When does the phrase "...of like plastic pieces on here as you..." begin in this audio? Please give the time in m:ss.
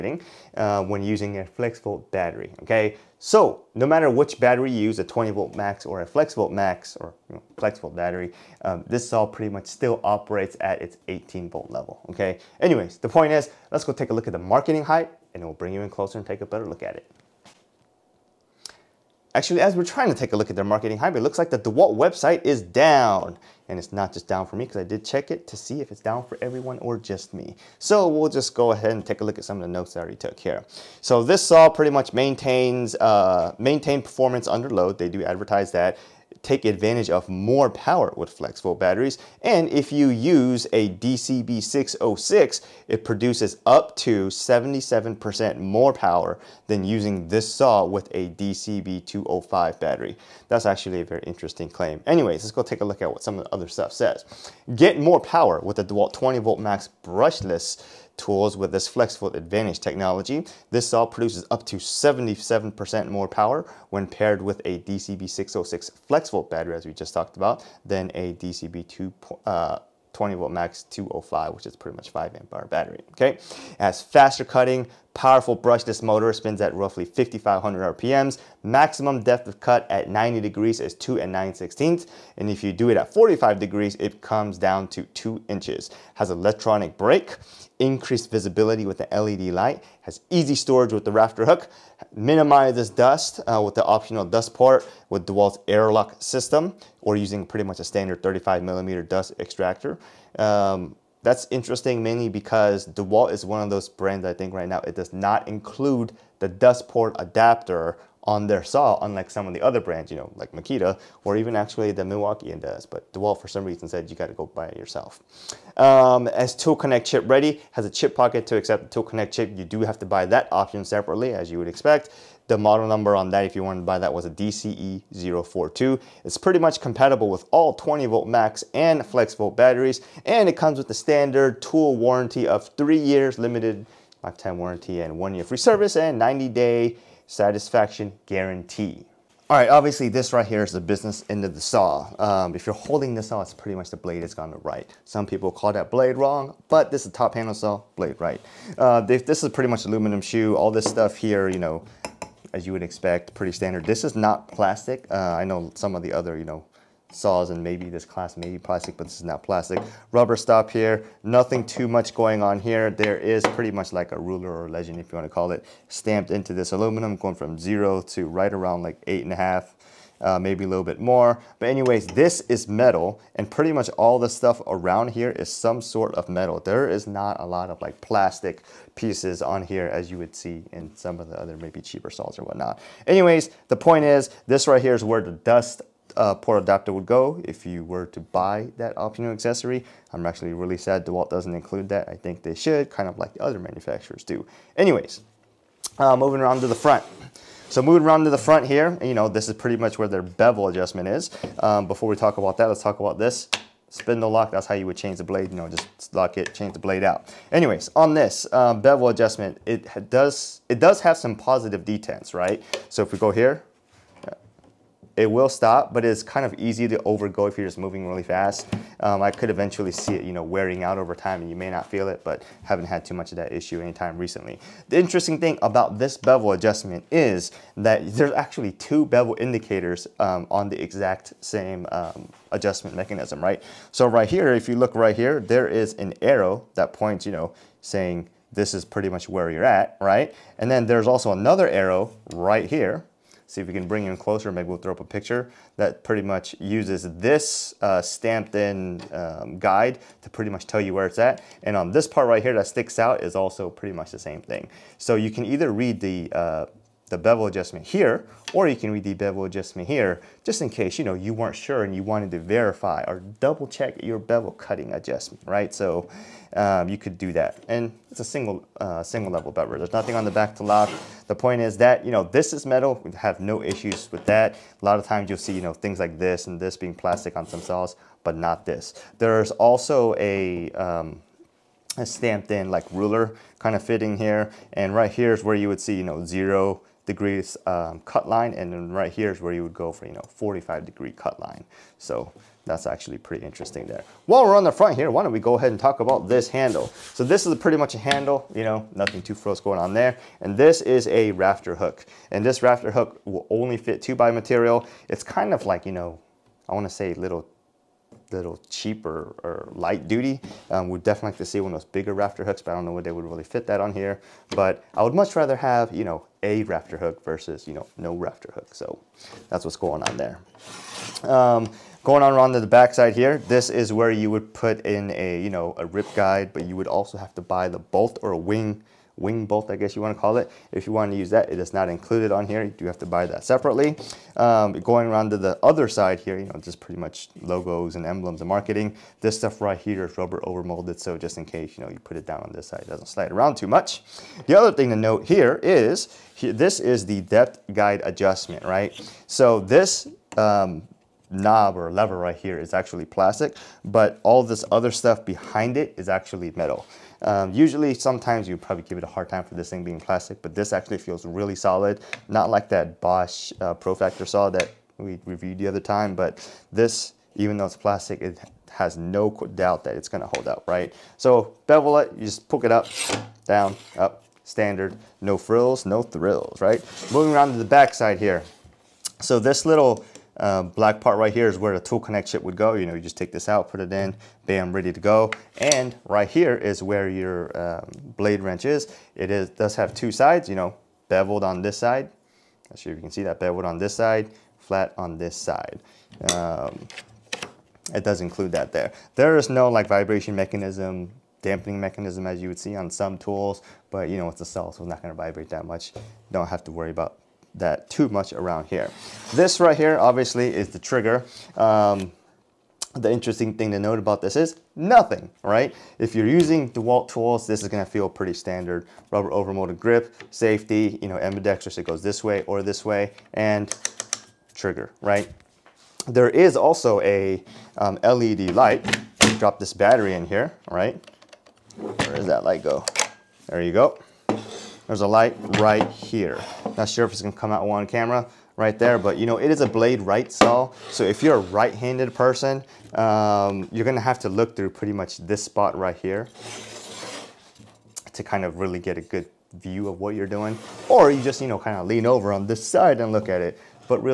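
2:57.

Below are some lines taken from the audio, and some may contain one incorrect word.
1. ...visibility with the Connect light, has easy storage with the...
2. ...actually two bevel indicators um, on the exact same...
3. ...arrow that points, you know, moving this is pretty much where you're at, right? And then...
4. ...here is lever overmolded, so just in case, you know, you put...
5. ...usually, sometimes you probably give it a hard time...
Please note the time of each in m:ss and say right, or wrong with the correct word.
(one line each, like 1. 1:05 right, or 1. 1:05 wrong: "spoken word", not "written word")
1. 1:28 wrong: "LED", not "Connect"
2. 3:48 right
3. 3:56 wrong: "saying", not "moving"
4. 5:39 wrong: "rubber", not "lever"
5. 5:57 right.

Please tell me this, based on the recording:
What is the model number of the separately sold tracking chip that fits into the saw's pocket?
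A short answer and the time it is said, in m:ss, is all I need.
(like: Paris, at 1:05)
DCE042, at 2:04.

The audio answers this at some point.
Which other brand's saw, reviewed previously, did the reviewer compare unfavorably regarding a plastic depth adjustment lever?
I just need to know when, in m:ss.
6:02.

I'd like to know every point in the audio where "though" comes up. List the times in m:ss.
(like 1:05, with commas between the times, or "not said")
6:07.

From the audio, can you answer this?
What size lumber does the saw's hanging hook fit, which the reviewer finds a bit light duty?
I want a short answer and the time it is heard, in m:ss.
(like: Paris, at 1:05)
2 by material, at 5:04.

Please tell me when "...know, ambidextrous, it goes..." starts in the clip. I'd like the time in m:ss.
7:01.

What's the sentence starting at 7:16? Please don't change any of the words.
Not sure if it's gonna come out on camera right there, but you know, it is a blade right saw.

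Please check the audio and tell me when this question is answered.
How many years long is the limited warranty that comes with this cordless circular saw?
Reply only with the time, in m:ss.
2:12.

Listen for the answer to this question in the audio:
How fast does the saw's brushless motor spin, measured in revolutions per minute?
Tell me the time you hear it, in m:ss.
1:17.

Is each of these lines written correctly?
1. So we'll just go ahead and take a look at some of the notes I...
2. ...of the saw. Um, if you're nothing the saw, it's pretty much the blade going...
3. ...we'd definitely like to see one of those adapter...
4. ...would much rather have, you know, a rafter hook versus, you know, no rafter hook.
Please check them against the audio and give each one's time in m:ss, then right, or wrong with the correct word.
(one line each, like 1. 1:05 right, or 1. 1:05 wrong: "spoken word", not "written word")
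1. 0:27 right
2. 2:21 wrong: "holding", not "nothing"
3. 5:10 wrong: "bigger", not "adapter"
4. 5:15 right.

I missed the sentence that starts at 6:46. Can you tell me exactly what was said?
Don't have to worry about that too much around here.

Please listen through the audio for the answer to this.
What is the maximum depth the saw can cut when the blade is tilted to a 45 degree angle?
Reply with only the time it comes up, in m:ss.
1:25.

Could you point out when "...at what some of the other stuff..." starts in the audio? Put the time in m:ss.
0:53.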